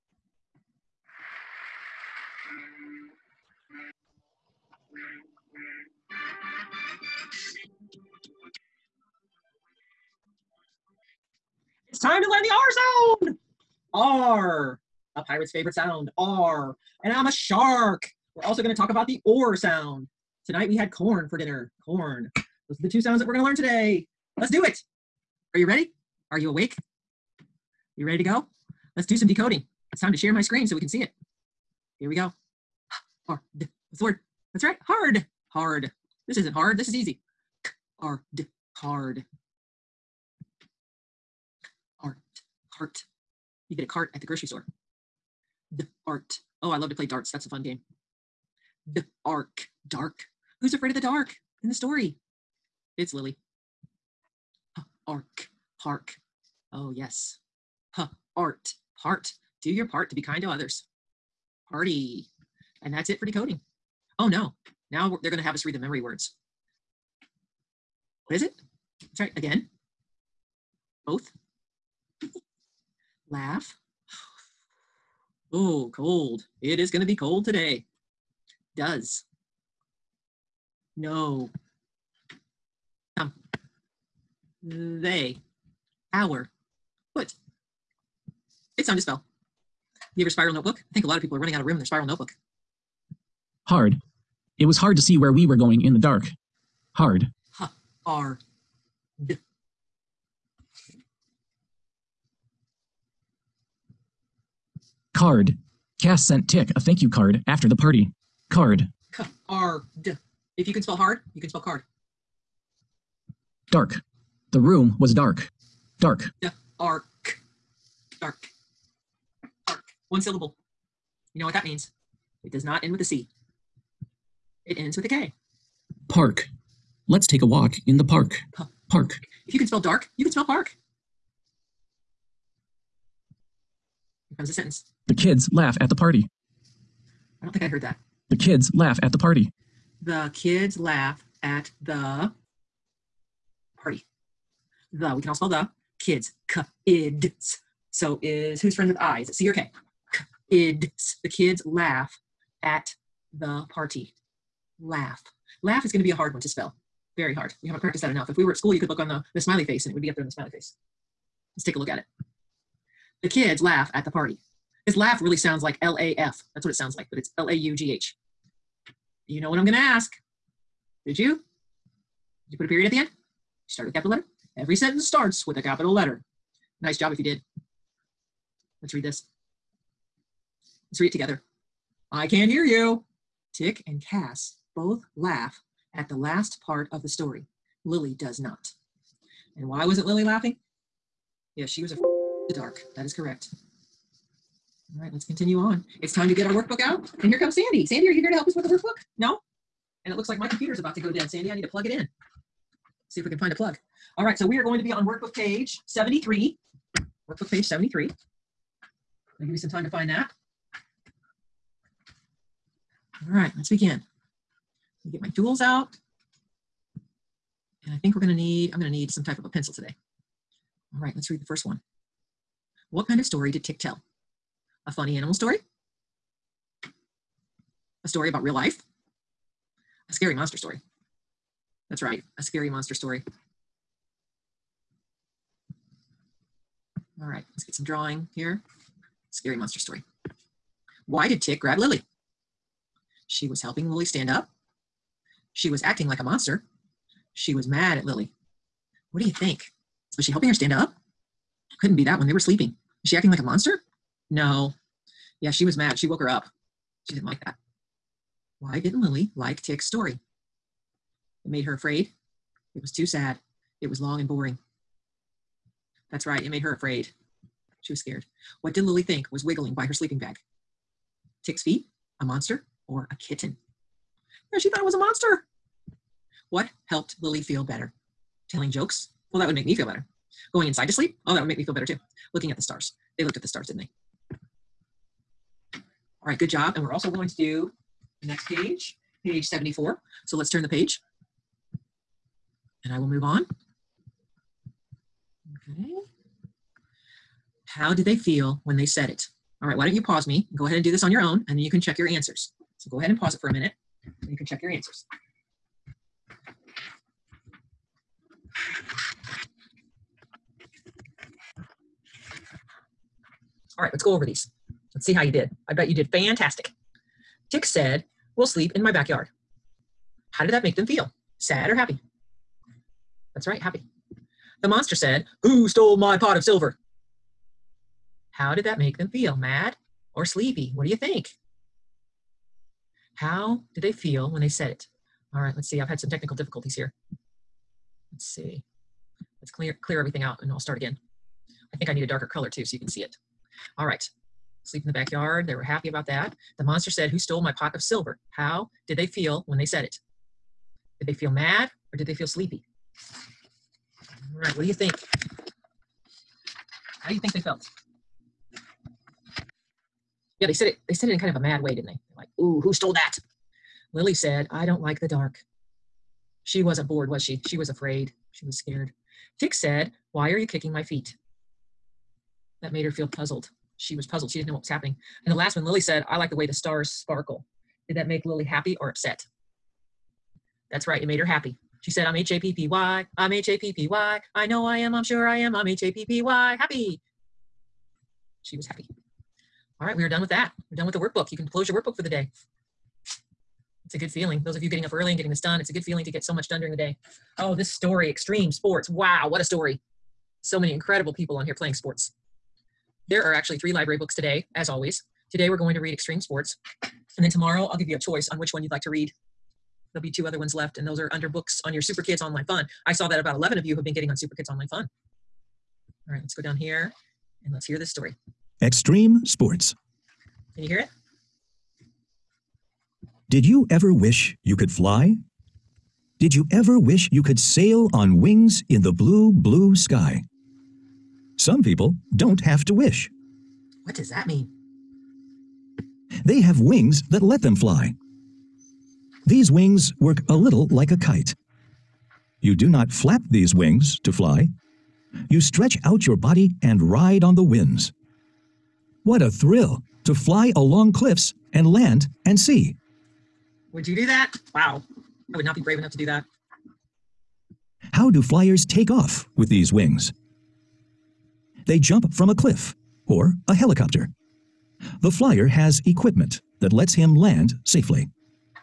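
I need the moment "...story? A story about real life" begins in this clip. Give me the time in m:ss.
3:45.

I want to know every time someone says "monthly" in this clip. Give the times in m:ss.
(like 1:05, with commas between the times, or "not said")
not said.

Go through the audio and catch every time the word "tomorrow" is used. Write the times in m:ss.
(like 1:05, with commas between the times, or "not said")
6:47.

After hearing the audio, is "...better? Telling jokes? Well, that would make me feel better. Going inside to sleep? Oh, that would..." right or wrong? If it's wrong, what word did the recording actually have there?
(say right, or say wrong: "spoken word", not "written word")
right.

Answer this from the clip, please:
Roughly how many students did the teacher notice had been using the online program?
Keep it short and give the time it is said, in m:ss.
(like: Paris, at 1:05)
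11, at 6:53.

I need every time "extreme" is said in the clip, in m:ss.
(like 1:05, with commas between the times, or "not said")
6:38, 6:45, 6:58.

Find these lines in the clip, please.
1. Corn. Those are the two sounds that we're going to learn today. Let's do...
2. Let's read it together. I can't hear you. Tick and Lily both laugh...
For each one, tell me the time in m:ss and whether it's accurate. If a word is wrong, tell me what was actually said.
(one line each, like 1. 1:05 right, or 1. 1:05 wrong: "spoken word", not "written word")
1. 0:21 right
2. 3:00 wrong: "Cass", not "Lily".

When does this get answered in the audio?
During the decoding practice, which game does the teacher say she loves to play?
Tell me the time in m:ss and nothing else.
0:46.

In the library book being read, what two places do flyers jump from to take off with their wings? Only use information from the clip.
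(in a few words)
A cliff or a helicopter.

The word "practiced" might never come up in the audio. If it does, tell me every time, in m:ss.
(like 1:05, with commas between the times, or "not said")
2:37.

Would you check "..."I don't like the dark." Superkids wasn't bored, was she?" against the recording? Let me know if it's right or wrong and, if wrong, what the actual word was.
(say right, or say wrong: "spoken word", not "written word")
wrong: "She", not "Superkids".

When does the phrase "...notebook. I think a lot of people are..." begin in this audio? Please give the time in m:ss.
1:30.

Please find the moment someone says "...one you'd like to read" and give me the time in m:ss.
6:48.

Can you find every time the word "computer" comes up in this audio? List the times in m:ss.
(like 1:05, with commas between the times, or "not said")
3:20.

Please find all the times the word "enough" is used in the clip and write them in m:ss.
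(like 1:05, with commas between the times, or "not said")
2:38, 7:35.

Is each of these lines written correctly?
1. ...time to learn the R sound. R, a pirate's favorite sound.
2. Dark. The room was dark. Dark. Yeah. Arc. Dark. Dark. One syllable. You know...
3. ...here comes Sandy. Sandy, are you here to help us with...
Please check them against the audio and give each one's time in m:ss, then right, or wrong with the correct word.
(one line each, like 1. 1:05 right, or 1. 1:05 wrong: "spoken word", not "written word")
1. 0:11 right
2. 1:53 right
3. 3:17 right.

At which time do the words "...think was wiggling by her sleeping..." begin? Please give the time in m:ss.
4:29.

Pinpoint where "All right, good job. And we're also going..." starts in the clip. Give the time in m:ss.
4:45.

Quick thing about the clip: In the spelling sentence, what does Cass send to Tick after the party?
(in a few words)
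A thank you card.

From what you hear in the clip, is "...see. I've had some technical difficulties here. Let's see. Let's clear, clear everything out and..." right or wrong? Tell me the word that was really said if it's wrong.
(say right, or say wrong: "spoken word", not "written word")
right.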